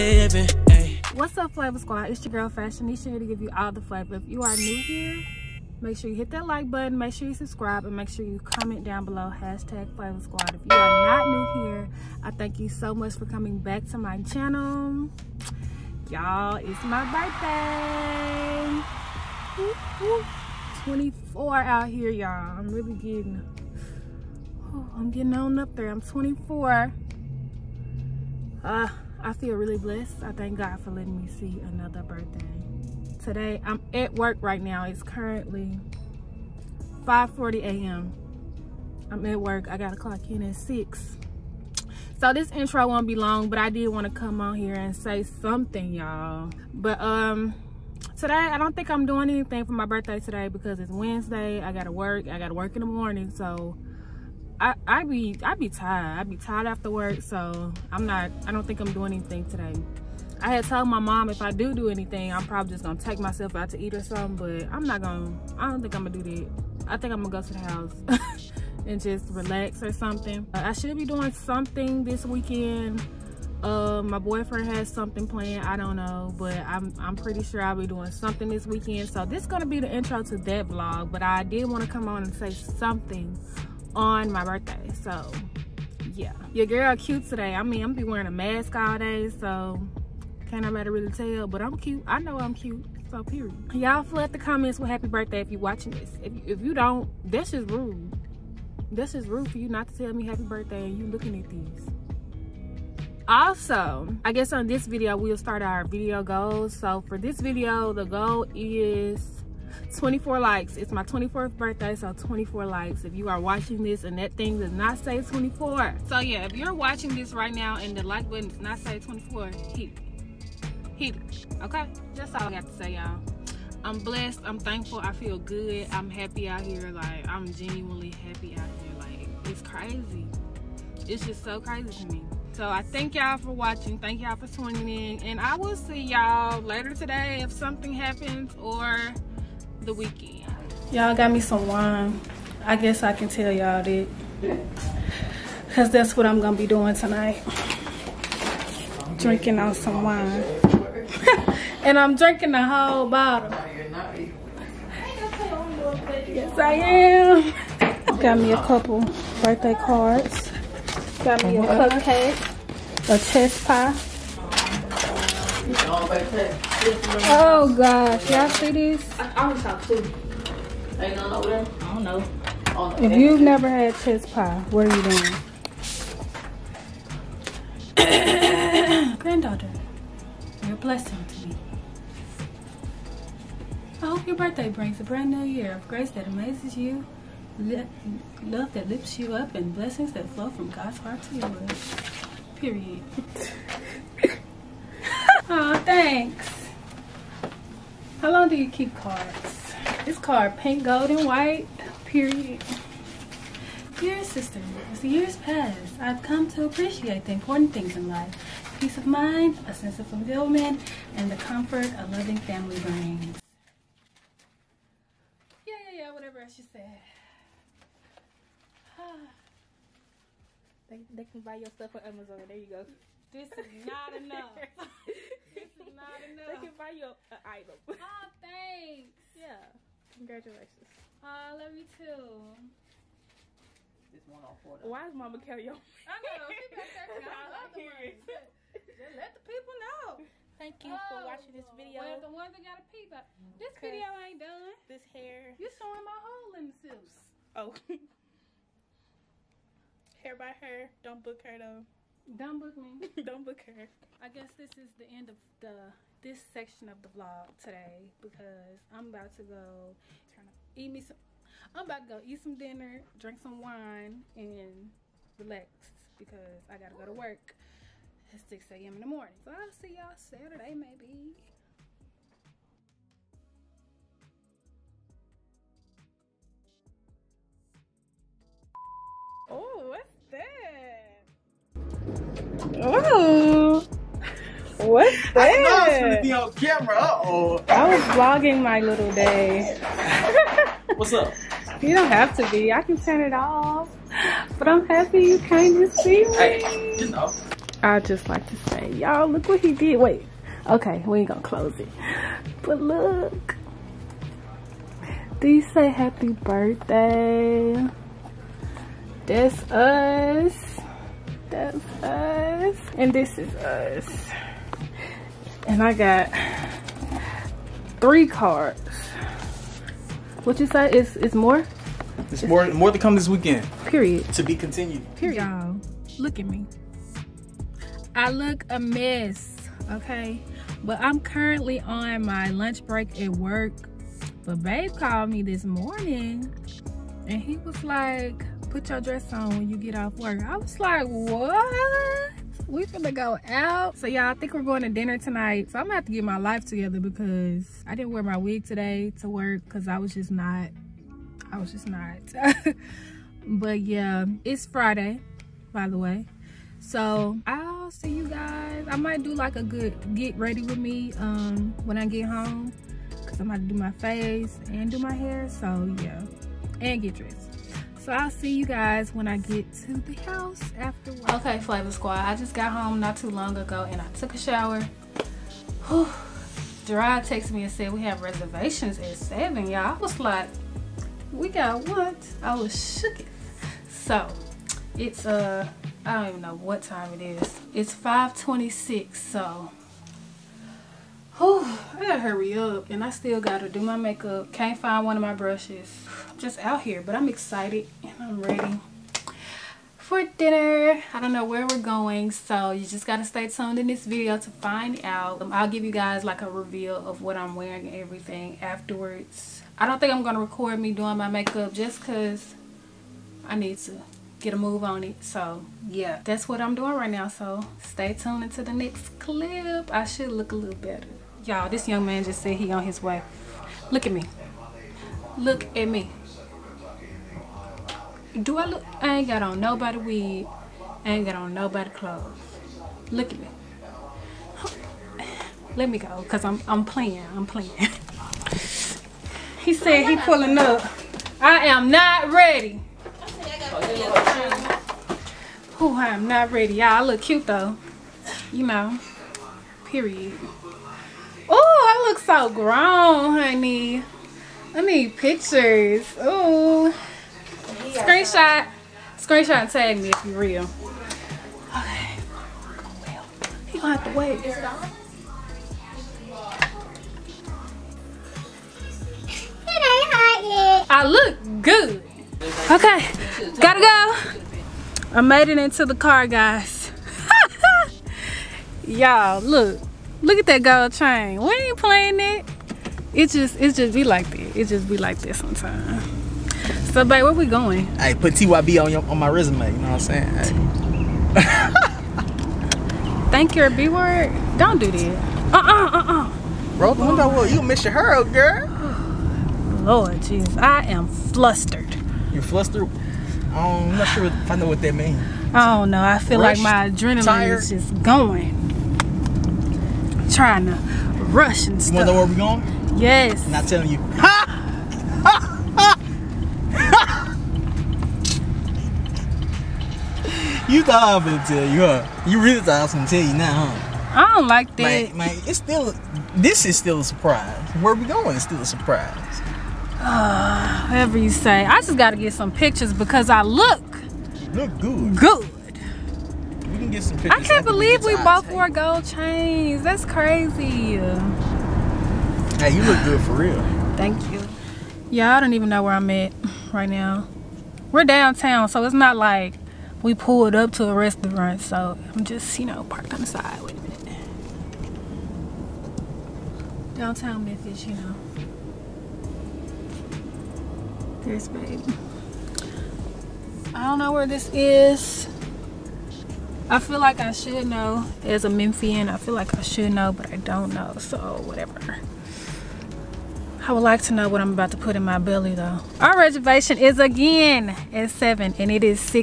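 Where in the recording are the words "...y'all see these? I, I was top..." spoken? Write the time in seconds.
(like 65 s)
168 s.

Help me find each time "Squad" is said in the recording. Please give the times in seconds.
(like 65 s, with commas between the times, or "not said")
1 s, 10 s, 371 s.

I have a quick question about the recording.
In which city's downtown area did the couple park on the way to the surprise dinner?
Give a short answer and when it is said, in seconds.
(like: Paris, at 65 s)
Memphis, at 556 s.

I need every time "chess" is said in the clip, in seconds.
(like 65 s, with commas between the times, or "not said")
163 s, 173 s.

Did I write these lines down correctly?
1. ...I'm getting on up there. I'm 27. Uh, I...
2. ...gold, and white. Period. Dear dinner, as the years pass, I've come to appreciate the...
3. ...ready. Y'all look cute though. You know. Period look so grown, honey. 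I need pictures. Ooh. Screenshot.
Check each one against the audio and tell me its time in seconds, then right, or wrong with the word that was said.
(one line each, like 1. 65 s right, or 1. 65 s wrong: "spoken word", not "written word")
1. 24 s wrong: "24", not "27"
2. 200 s wrong: "sister", not "dinner"
3. 446 s right.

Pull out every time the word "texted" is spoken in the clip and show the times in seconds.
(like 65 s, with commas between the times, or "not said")
377 s.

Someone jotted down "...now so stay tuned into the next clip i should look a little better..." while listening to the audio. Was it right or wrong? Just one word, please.
right.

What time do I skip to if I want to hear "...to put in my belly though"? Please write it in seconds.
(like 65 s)
574 s.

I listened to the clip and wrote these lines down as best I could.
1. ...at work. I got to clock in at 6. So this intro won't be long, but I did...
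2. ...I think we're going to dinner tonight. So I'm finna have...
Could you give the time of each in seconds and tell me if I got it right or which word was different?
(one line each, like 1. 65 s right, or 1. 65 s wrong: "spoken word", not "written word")
1. 39 s right
2. 344 s wrong: "gonna", not "finna".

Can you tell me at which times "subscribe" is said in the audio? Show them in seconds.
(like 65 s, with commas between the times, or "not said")
7 s.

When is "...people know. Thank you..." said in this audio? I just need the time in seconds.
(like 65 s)
239 s.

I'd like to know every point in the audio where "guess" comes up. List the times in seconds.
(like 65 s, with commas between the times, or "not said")
104 s, 142 s, 254 s.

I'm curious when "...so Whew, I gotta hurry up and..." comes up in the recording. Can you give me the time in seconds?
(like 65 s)
389 s.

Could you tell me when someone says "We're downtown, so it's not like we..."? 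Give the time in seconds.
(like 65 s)
547 s.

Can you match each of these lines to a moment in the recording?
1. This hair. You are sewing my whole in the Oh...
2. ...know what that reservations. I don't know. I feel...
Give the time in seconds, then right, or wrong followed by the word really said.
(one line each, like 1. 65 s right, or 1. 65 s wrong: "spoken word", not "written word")
1. 244 s right
2. 504 s wrong: "means", not "reservations".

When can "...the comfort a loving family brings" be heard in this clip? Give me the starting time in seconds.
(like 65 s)
211 s.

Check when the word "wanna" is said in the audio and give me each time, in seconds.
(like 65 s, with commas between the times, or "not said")
511 s.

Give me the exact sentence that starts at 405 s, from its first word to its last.
Um, I'll give you guys like a reveal of what I'm wearing and everything afterwards.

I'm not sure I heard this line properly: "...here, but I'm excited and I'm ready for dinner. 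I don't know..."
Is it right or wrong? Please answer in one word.
right.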